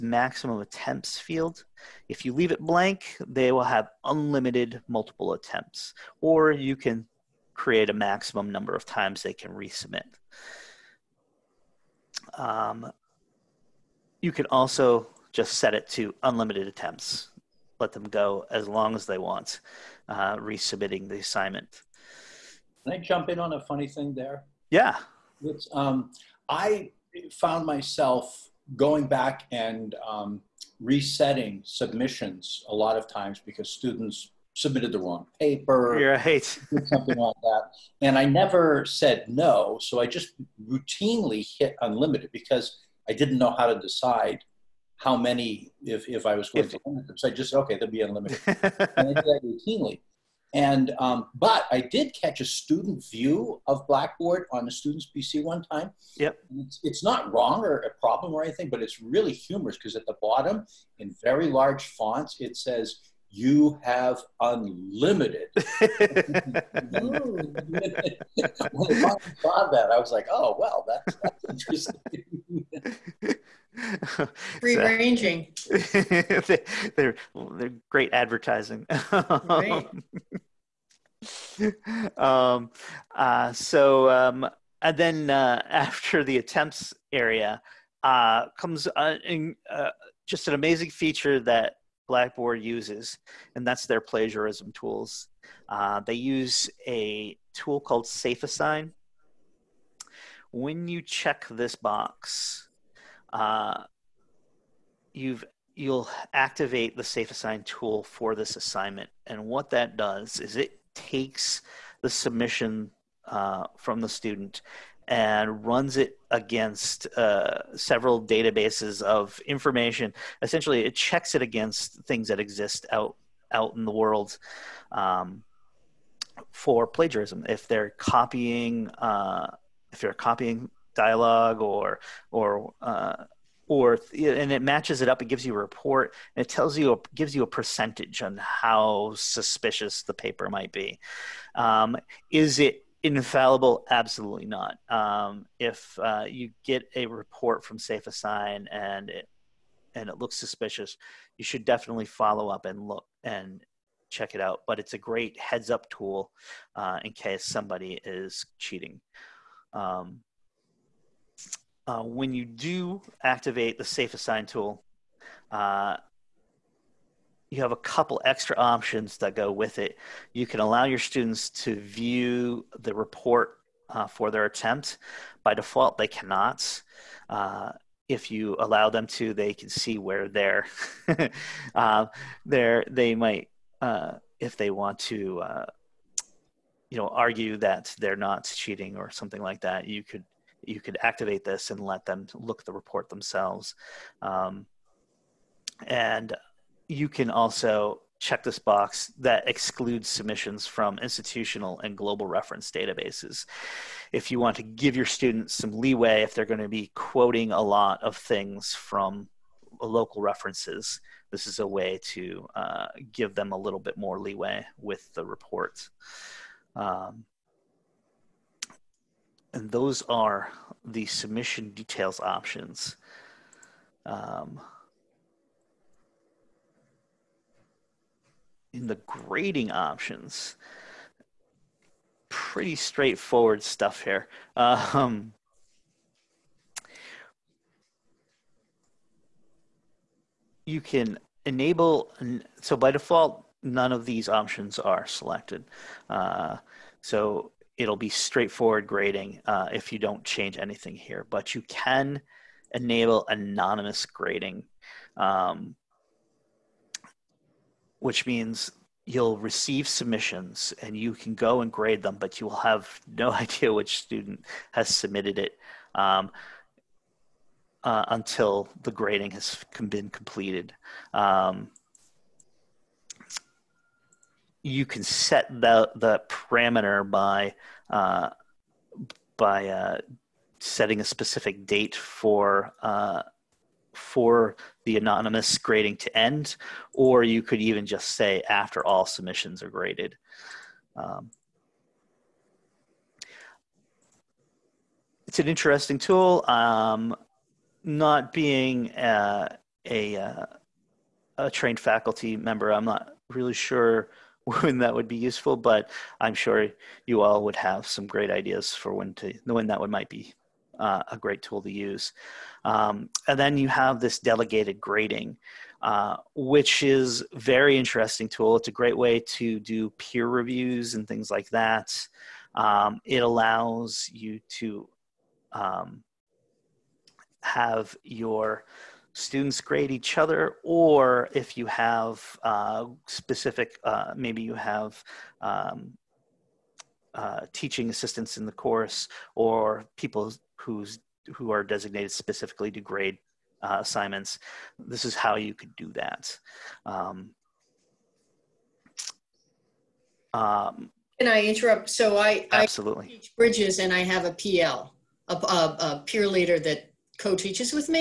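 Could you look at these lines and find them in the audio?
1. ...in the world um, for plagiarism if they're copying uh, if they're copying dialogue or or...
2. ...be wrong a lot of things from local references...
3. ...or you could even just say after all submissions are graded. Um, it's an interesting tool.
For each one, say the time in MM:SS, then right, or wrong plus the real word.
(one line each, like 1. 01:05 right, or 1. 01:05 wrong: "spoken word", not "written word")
1. 02:03 right
2. 03:26 wrong: "quoting", not "wrong"
3. 04:46 right.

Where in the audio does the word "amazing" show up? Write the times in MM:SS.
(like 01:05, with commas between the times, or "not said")
01:30.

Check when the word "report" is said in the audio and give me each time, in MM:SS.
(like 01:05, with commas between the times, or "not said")
02:15, 02:27, 02:52, 03:12, 03:35.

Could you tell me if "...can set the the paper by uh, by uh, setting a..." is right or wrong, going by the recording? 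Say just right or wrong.
wrong.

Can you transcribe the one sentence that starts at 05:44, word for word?
This is how you could do that.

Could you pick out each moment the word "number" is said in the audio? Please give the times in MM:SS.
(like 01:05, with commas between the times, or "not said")
00:08.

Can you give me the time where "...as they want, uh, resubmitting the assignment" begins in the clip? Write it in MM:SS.
00:18.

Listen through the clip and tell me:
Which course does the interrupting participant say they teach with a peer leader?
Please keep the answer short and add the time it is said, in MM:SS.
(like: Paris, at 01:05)
bridges, at 05:53.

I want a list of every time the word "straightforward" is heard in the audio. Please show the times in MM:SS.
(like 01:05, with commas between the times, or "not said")
03:52, 04:08.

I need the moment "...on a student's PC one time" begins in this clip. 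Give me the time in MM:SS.
00:54.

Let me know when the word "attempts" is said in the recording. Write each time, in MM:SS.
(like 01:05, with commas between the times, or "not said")
00:00, 00:05, 00:16, 01:26, 02:54.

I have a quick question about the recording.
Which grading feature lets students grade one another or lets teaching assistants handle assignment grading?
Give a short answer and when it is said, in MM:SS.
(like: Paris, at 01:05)
delegated grading, at 05:14.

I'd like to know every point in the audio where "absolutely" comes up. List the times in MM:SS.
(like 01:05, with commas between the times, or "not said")
02:23, 05:52.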